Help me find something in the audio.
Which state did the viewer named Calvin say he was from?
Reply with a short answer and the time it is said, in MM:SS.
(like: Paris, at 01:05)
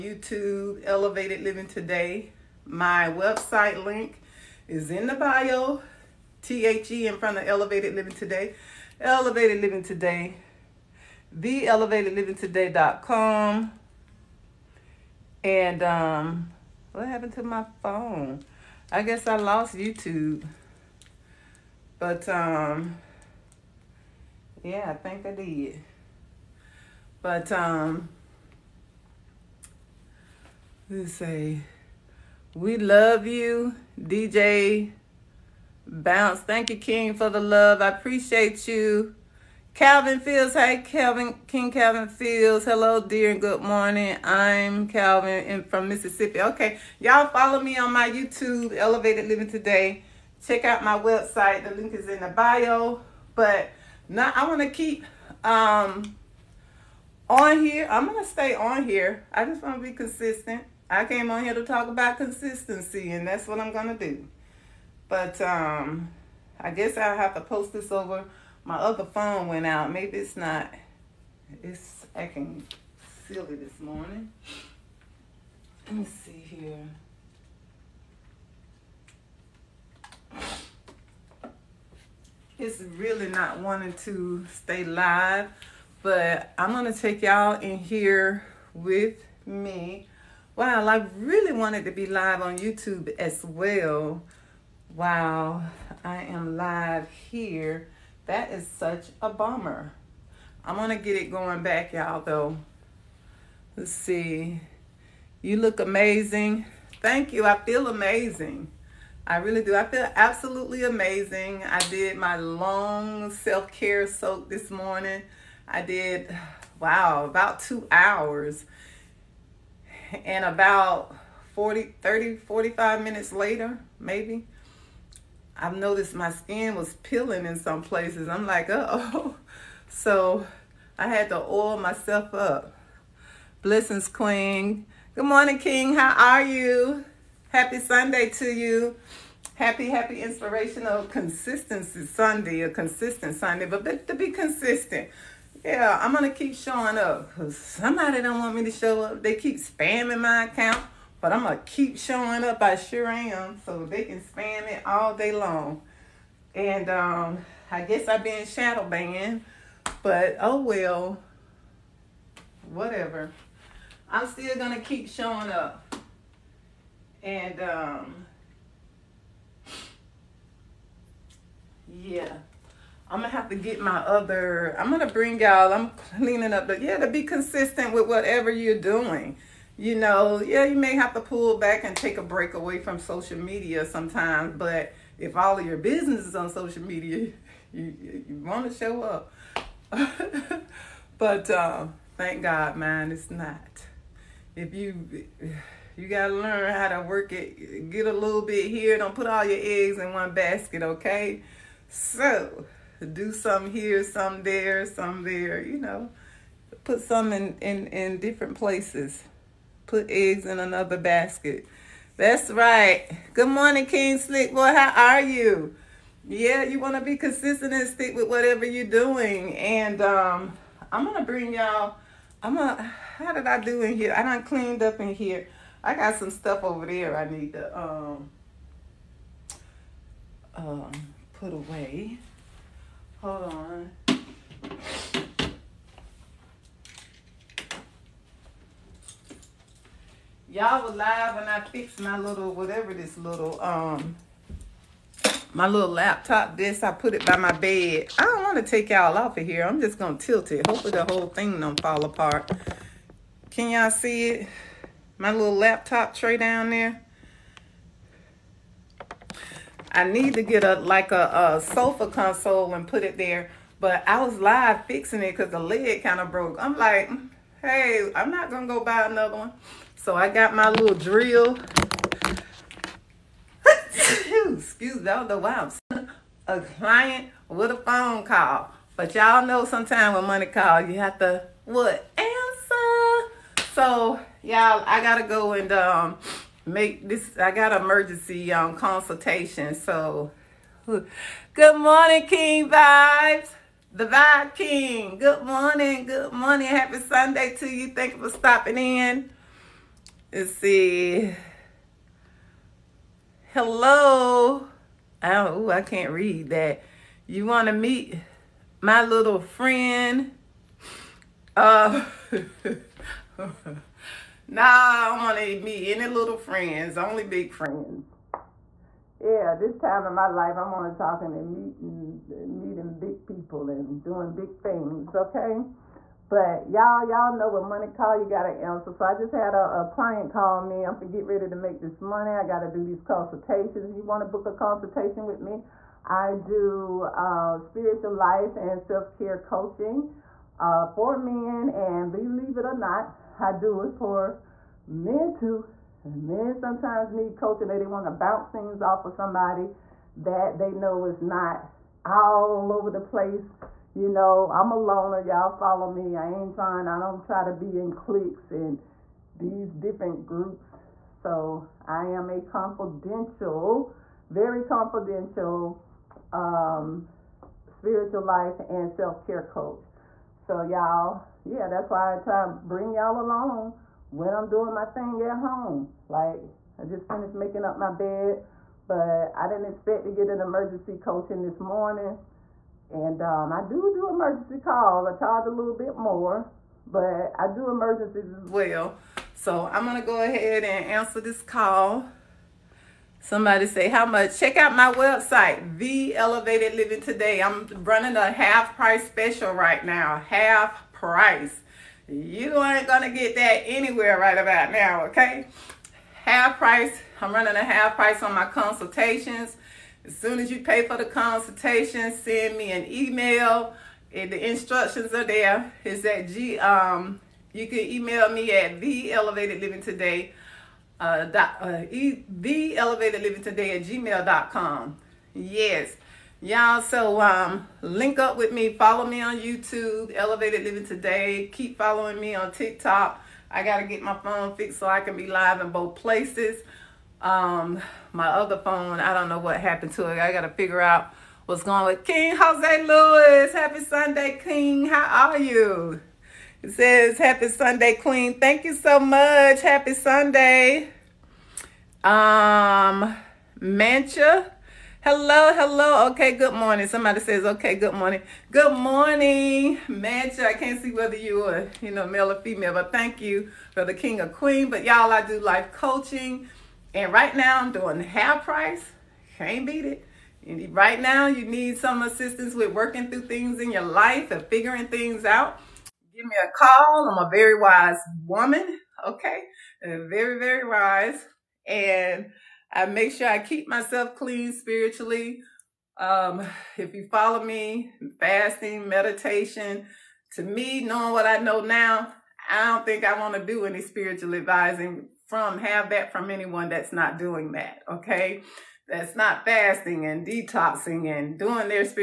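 Mississippi, at 00:45.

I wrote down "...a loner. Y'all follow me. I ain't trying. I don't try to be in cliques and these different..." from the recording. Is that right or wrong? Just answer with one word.
right.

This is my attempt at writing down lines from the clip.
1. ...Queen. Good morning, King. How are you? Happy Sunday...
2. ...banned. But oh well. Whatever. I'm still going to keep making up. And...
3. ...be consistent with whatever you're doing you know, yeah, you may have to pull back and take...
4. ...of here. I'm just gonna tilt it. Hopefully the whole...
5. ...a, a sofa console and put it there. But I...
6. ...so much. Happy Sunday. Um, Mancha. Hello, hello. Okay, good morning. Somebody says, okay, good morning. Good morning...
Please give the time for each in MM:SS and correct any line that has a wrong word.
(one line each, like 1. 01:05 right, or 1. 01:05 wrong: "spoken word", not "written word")
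1. 02:14 right
2. 02:38 wrong: "showing", not "making"
3. 02:57 right
4. 04:09 right
5. 04:21 right
6. 07:28 right.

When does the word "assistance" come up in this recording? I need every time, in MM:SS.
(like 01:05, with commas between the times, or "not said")
07:52.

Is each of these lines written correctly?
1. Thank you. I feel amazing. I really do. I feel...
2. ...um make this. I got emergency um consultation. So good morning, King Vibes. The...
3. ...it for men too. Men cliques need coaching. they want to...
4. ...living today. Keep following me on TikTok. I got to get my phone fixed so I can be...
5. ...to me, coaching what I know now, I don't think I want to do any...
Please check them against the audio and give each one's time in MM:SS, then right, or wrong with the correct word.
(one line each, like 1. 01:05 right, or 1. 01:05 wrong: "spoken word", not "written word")
1. 01:47 right
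2. 04:45 right
3. 05:43 wrong: "sometimes", not "cliques"
4. 07:10 right
5. 08:10 wrong: "knowing", not "coaching".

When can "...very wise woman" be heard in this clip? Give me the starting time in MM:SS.
07:57.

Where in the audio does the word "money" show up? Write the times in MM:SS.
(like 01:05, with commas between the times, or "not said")
04:40, 05:27, 05:32.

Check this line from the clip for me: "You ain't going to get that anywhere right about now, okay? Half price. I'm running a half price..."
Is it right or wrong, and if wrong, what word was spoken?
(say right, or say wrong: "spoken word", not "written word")
right.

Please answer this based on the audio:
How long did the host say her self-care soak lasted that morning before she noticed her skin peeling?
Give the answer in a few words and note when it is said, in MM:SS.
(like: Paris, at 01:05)
2 hours, at 01:57.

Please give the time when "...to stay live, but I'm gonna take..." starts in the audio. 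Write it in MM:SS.
01:24.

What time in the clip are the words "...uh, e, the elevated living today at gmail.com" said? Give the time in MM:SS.
07:01.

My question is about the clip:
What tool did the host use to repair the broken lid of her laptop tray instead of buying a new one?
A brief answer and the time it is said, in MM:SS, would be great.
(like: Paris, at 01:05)
Drill, at 04:30.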